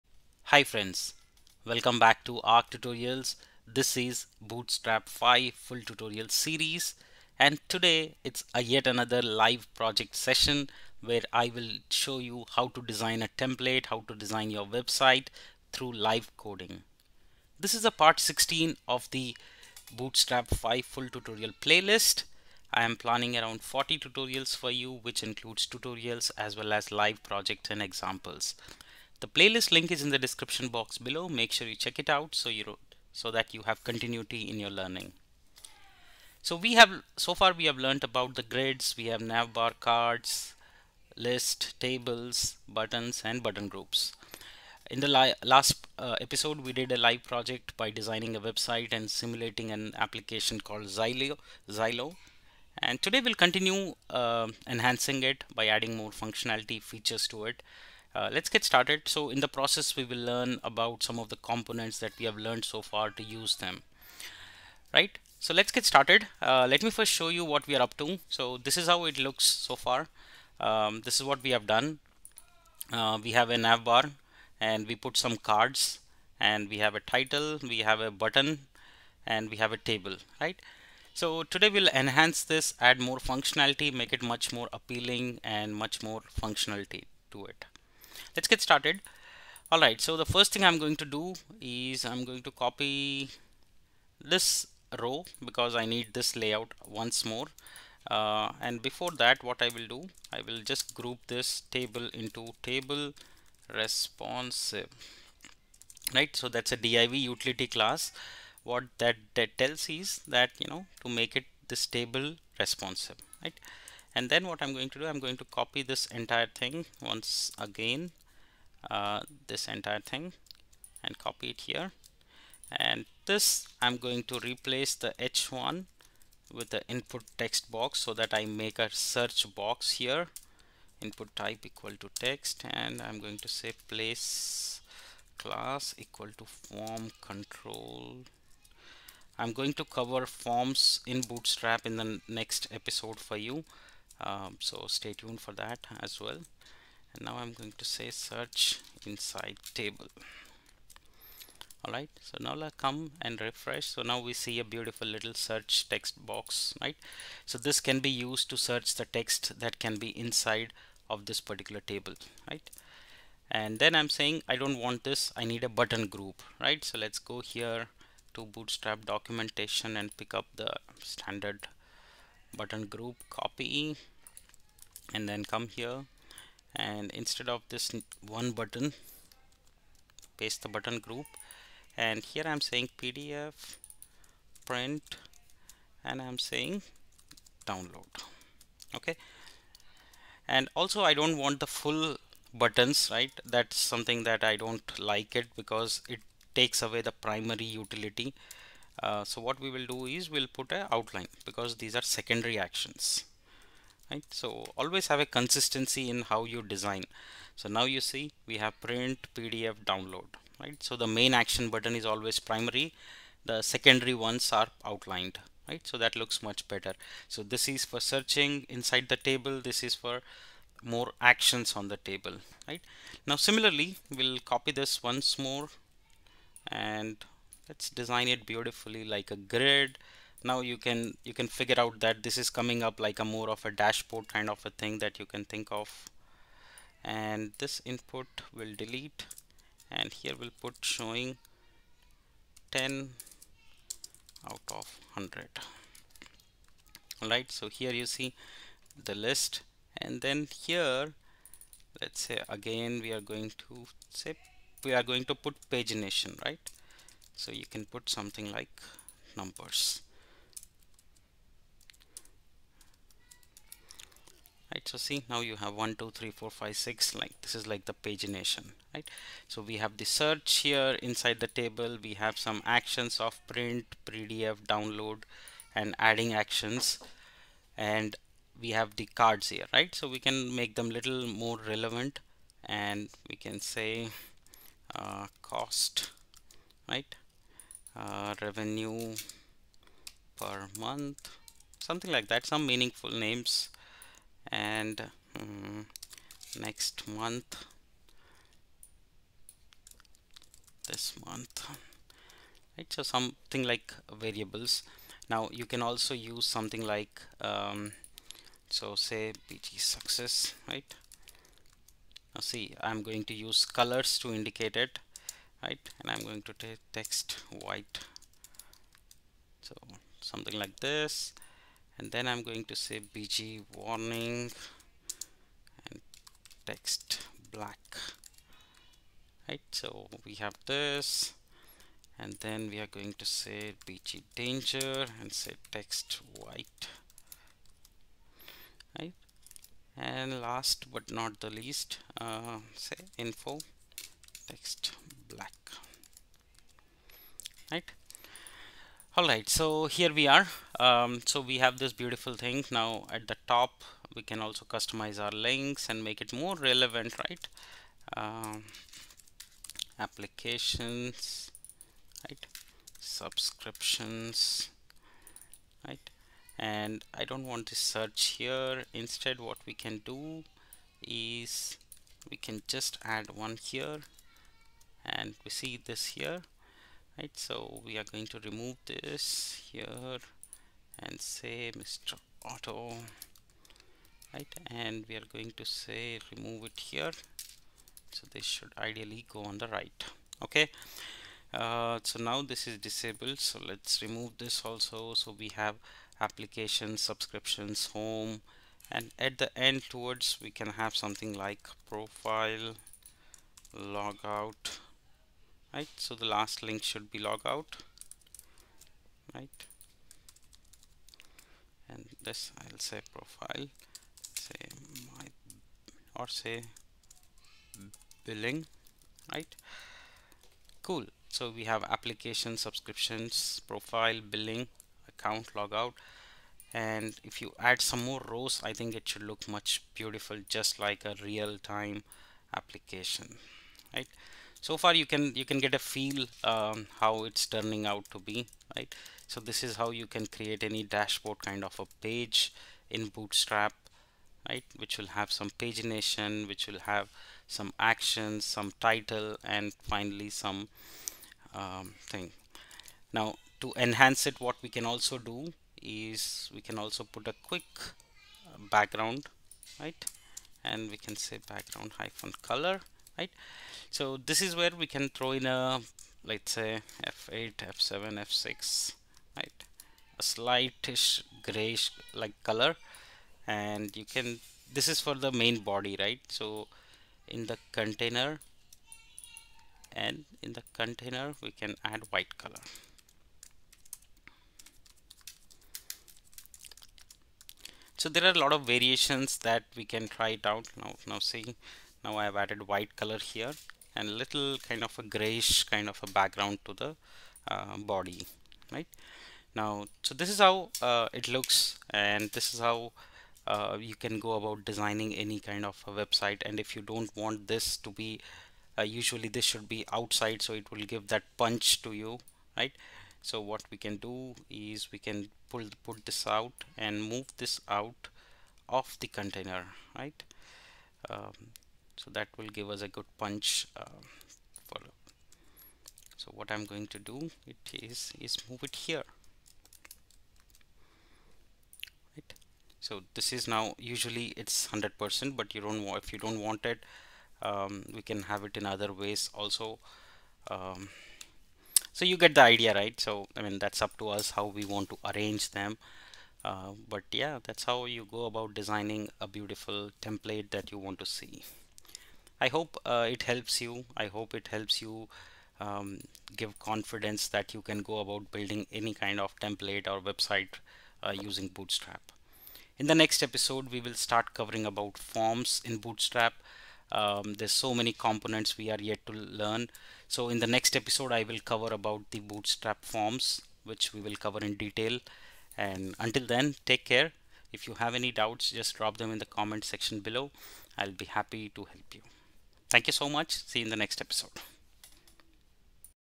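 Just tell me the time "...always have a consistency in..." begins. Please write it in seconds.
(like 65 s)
204 s.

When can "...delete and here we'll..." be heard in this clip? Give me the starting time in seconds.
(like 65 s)
238 s.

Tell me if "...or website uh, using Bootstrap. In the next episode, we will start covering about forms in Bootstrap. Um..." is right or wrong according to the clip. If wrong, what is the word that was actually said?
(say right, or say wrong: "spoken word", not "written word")
right.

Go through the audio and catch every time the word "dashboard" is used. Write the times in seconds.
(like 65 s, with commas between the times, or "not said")
233 s, 440 s.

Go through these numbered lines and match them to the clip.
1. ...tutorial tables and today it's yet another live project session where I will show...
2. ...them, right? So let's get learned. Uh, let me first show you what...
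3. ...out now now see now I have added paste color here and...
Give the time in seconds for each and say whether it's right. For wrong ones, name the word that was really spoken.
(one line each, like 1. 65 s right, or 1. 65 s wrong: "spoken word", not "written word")
1. 5 s wrong: "series", not "tables"
2. 63 s wrong: "started", not "learned"
3. 490 s wrong: "white", not "paste".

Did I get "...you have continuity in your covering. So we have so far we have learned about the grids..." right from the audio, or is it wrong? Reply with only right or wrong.
wrong.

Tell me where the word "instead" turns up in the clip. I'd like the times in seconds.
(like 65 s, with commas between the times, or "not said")
177 s, 368 s.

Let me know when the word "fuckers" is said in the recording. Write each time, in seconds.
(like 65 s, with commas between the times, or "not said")
not said.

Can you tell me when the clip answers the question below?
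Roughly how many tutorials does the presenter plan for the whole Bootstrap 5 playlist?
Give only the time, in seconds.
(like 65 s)
23 s.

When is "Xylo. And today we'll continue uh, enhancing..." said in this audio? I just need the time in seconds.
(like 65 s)
51 s.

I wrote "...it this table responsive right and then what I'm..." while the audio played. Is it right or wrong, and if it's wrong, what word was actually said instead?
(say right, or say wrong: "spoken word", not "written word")
right.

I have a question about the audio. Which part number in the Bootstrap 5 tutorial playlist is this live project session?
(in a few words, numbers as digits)
16.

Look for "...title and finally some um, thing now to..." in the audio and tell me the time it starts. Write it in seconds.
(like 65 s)
448 s.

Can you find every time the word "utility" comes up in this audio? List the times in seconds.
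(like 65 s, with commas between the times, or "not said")
107 s, 197 s.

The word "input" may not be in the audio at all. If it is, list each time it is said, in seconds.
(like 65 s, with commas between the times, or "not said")
126 s, 131 s, 237 s.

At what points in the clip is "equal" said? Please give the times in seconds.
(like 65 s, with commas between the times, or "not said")
131 s, 135 s.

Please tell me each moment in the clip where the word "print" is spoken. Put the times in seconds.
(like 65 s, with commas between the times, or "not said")
184 s, 208 s, 273 s.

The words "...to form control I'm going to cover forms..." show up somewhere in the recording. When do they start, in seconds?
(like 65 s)
136 s.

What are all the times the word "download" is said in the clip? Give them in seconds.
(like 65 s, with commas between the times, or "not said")
187 s, 209 s, 274 s.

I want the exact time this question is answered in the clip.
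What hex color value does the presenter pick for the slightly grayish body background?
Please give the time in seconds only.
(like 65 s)
467 s.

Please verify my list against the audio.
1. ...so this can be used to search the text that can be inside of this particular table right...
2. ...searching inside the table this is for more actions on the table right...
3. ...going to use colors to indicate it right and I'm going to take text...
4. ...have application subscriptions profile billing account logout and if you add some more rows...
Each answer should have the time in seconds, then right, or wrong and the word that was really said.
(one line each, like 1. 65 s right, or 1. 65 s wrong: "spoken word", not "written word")
1. 157 s right
2. 218 s right
3. 313 s right
4. 421 s right.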